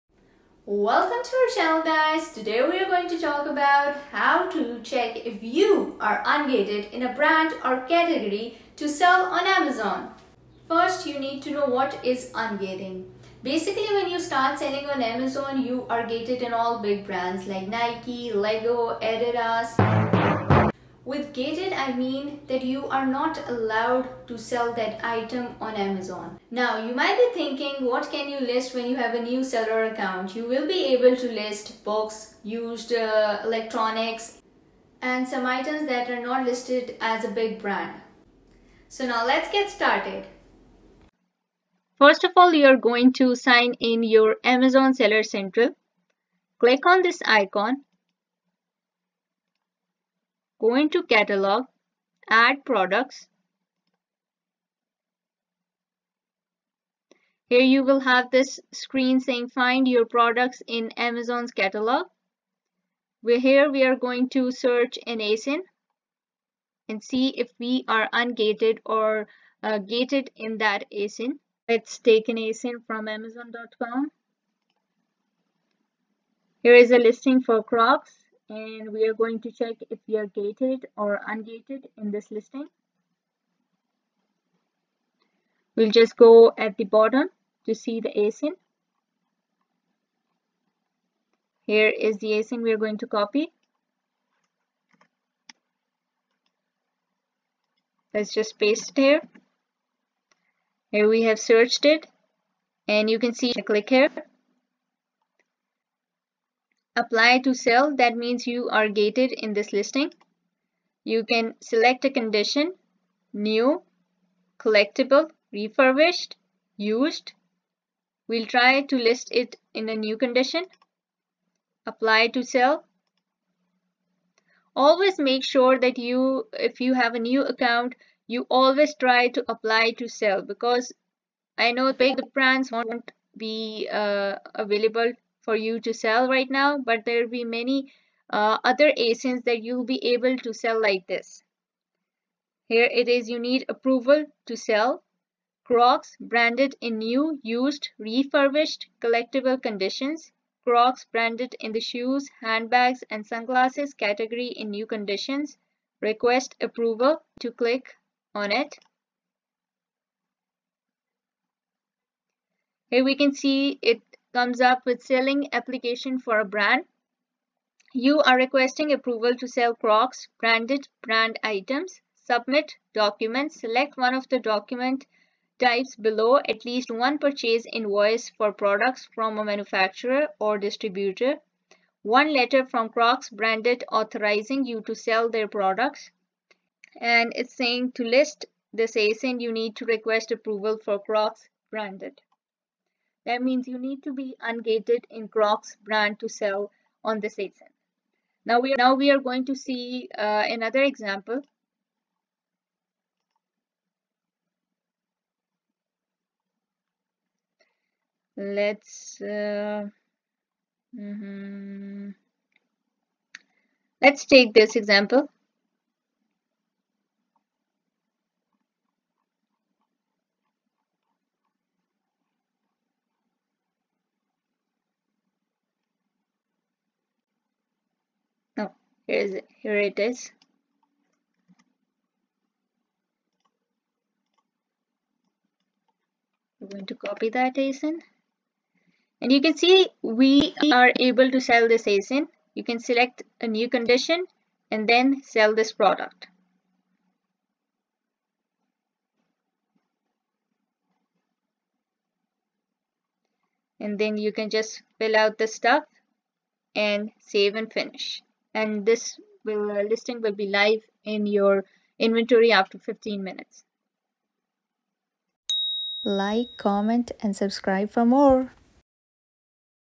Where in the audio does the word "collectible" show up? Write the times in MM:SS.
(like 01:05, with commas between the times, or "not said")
01:54, 02:29.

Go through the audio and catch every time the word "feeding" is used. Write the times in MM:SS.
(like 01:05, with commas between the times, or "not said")
not said.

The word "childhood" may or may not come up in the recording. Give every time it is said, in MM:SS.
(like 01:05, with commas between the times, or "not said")
not said.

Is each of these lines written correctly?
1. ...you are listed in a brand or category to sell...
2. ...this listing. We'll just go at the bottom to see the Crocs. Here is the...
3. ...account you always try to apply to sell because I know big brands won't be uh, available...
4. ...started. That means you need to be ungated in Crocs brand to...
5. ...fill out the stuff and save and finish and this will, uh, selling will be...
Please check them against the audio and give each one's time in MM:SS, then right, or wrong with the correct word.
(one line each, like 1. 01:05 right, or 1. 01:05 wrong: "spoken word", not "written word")
1. 00:05 wrong: "ungated", not "listed"
2. 01:22 wrong: "ASIN", not "Crocs"
3. 02:07 right
4. 03:11 wrong: "branded", not "started"
5. 04:14 wrong: "listing", not "selling".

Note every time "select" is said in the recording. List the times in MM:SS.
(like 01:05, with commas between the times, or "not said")
01:51, 02:53, 04:02.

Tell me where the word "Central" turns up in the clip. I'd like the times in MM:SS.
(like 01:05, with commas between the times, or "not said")
00:45.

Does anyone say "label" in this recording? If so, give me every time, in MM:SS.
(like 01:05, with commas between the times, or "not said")
not said.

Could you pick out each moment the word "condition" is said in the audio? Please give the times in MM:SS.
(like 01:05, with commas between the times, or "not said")
01:52, 02:00, 02:29, 02:34, 04:03.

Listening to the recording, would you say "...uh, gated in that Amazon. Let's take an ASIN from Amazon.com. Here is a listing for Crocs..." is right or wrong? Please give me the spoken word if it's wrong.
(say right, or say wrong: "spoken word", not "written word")
wrong: "ASIN", not "Amazon".